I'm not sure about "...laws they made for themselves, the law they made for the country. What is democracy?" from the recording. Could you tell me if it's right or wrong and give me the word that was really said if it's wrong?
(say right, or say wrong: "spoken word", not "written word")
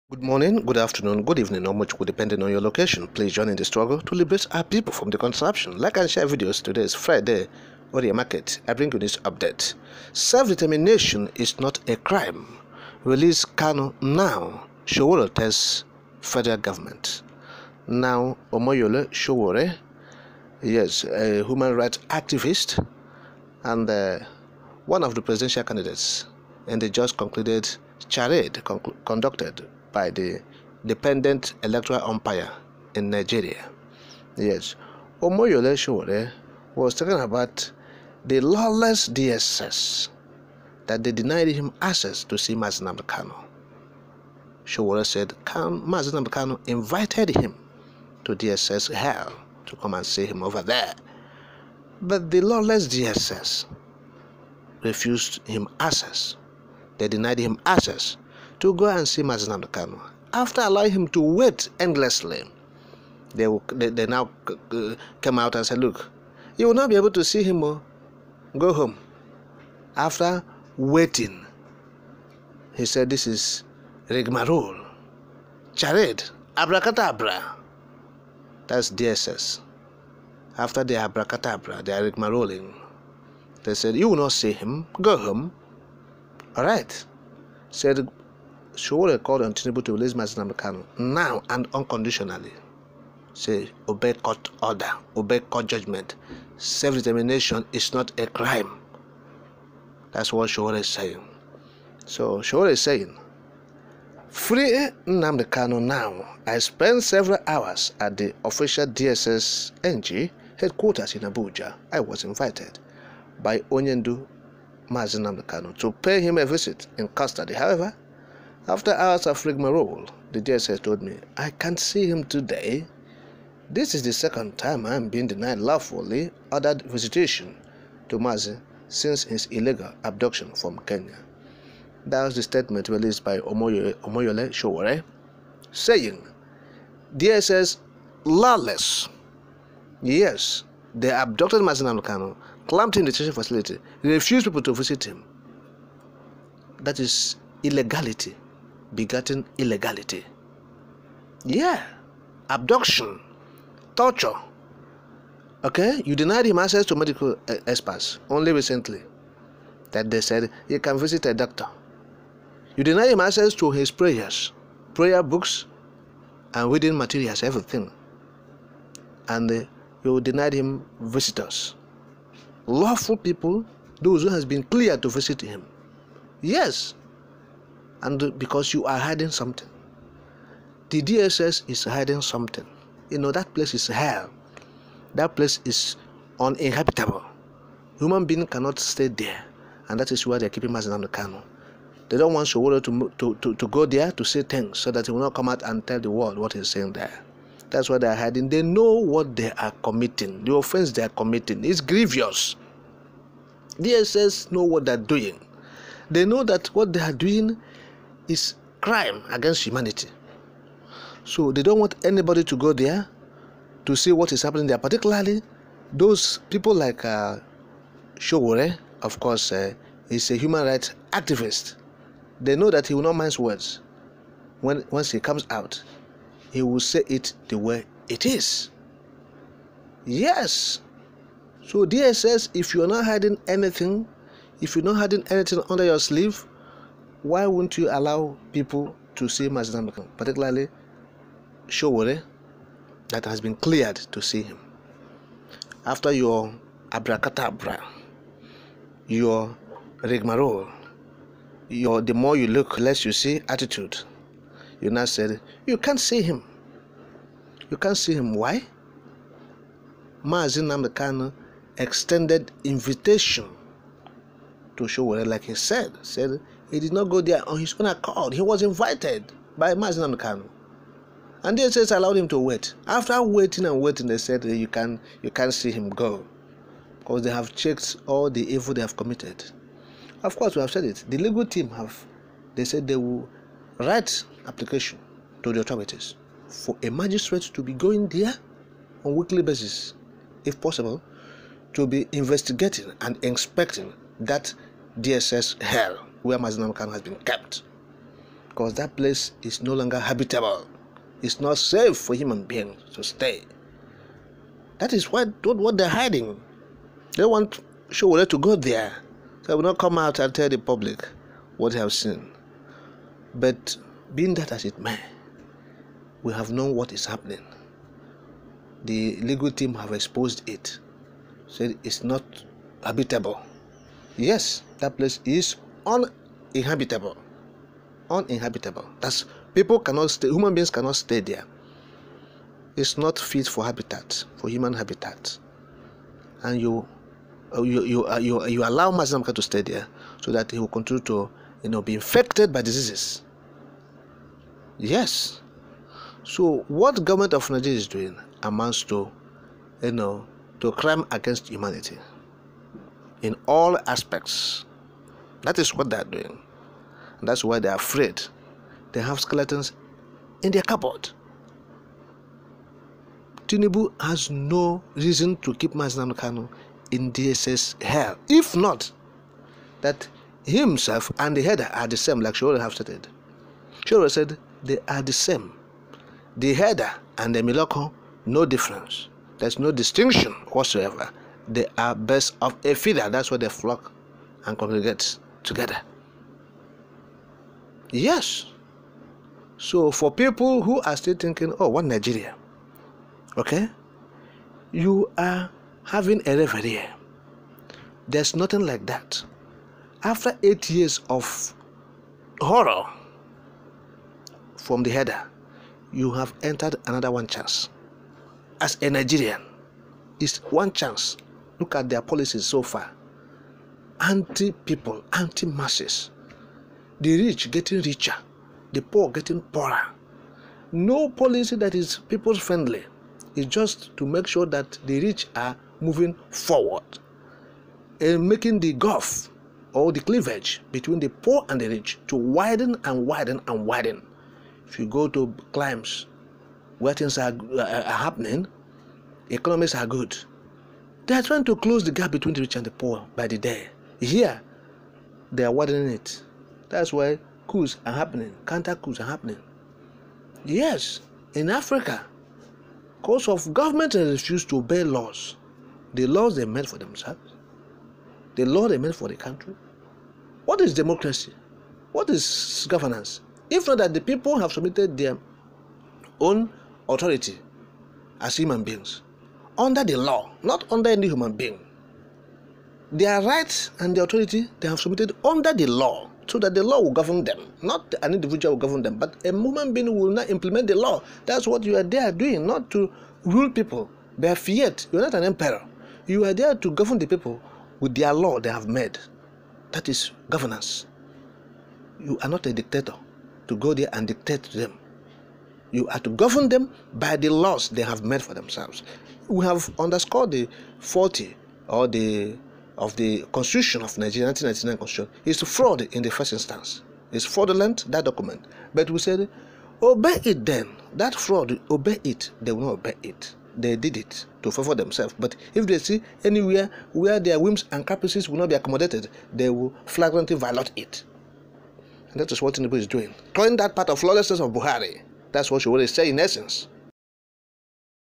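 right.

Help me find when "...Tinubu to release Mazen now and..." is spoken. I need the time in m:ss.
1:29.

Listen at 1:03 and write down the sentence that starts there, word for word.
They, they, they now come out and say, Look, you will not be able to see him.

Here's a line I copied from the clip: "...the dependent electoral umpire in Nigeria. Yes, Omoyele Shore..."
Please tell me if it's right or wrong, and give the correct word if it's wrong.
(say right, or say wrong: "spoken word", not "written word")
right.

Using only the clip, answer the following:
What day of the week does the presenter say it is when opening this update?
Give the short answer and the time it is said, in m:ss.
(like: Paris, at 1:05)
Friday, at 0:06.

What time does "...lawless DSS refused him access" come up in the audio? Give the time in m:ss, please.
0:52.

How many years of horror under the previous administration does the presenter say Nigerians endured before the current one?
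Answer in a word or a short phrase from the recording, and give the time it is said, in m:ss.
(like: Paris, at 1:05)
8, at 6:40.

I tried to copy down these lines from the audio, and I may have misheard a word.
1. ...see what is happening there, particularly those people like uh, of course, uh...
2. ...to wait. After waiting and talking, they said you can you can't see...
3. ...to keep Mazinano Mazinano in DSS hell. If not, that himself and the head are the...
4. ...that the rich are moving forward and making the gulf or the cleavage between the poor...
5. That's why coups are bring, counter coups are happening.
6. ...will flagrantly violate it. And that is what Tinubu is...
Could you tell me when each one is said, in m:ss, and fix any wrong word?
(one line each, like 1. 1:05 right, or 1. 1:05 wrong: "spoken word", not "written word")
1. 3:33 right
2. 4:32 wrong: "waiting", not "talking"
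3. 6:05 wrong: "Kanu", not "Mazinano"
4. 7:04 right
5. 7:26 wrong: "happening", not "bring"
6. 8:39 right.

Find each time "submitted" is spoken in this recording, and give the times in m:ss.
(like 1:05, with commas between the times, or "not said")
7:44, 7:54.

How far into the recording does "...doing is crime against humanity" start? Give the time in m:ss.
3:27.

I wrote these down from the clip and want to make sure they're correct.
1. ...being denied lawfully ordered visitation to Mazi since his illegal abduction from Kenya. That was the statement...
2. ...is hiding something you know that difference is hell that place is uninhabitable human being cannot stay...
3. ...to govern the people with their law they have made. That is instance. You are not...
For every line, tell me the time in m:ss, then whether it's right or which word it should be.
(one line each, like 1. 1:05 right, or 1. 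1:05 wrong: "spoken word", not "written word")
1. 2:05 right
2. 3:01 wrong: "place", not "difference"
3. 8:06 wrong: "governance", not "instance".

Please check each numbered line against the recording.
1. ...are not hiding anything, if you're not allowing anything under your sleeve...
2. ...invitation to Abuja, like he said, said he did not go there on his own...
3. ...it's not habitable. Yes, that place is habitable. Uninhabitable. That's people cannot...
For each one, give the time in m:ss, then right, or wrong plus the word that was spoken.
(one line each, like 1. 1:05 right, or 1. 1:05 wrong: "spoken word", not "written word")
1. 3:52 wrong: "hiding", not "allowing"
2. 4:22 wrong: "Sowore", not "Abuja"
3. 5:21 wrong: "uninhabitable", not "habitable".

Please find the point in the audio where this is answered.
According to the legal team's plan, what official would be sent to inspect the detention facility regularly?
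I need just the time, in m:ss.
4:46.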